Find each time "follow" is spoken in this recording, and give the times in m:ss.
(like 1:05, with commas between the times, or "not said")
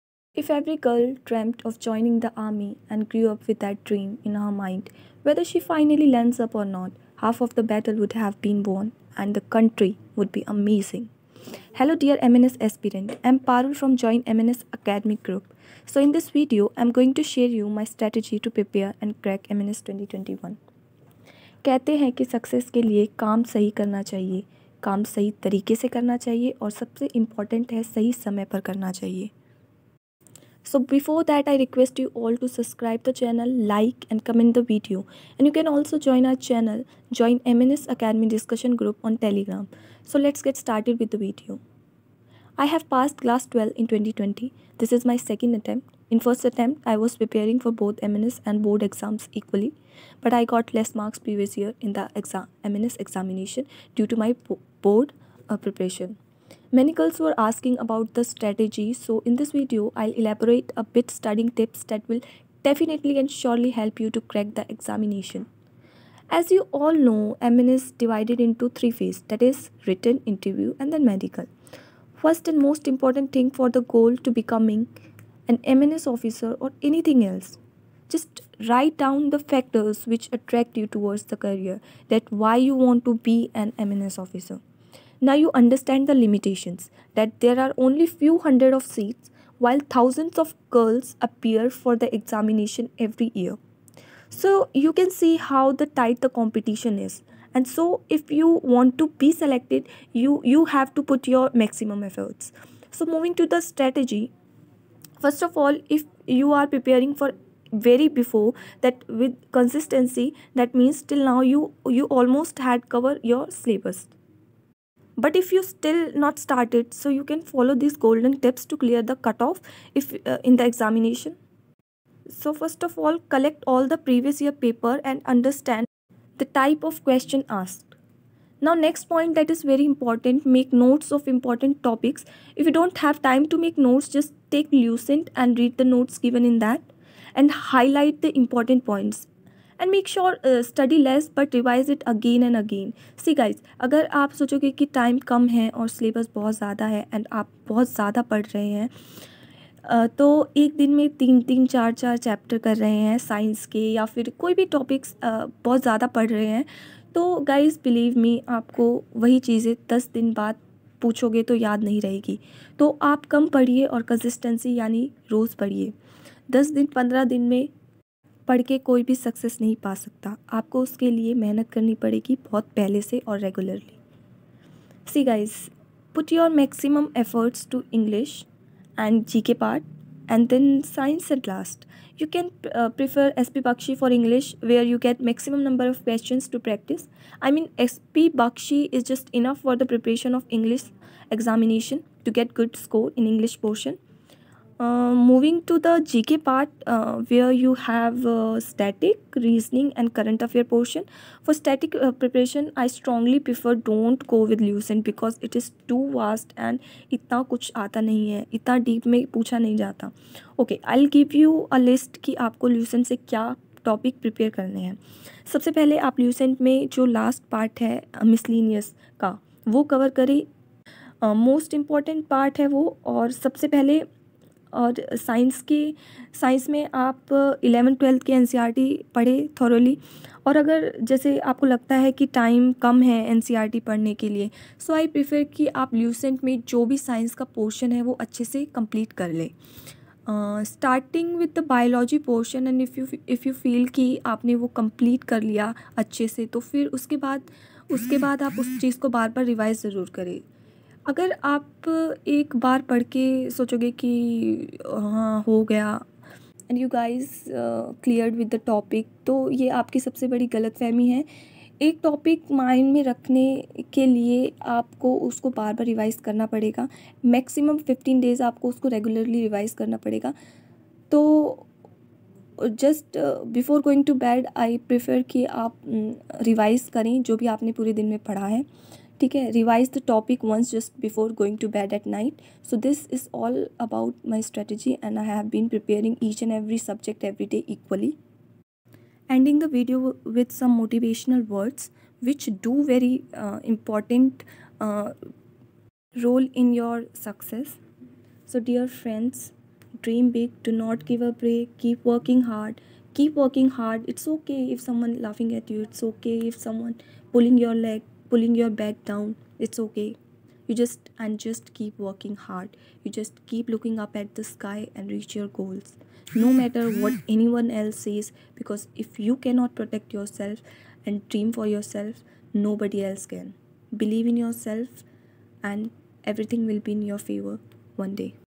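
1:57.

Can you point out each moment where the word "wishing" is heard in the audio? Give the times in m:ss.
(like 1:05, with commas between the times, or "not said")
not said.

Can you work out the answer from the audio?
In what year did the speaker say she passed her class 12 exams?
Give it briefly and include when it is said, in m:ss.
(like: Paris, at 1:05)
2020, at 0:43.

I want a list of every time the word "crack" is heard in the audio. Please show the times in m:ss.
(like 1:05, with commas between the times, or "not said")
0:19, 1:04.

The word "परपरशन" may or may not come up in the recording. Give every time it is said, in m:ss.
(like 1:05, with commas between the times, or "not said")
3:09, 3:22.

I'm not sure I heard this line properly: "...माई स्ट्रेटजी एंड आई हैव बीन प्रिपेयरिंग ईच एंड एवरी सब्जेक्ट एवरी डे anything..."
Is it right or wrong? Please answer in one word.
wrong.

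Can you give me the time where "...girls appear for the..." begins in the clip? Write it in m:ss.
1:30.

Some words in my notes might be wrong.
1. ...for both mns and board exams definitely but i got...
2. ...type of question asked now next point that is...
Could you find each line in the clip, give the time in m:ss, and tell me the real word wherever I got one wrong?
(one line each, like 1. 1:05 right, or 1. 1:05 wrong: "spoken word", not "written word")
1. 0:47 wrong: "equally", not "definitely"
2. 2:06 right.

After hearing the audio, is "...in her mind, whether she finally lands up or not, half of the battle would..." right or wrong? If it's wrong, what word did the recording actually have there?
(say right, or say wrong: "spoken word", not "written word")
right.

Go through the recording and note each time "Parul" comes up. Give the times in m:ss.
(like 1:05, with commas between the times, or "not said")
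0:13.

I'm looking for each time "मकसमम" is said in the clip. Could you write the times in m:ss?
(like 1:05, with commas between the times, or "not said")
2:56, 3:05, 4:27.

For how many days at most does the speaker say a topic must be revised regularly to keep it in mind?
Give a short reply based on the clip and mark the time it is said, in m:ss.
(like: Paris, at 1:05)
15, at 4:27.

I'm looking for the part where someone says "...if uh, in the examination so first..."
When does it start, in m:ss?
1:59.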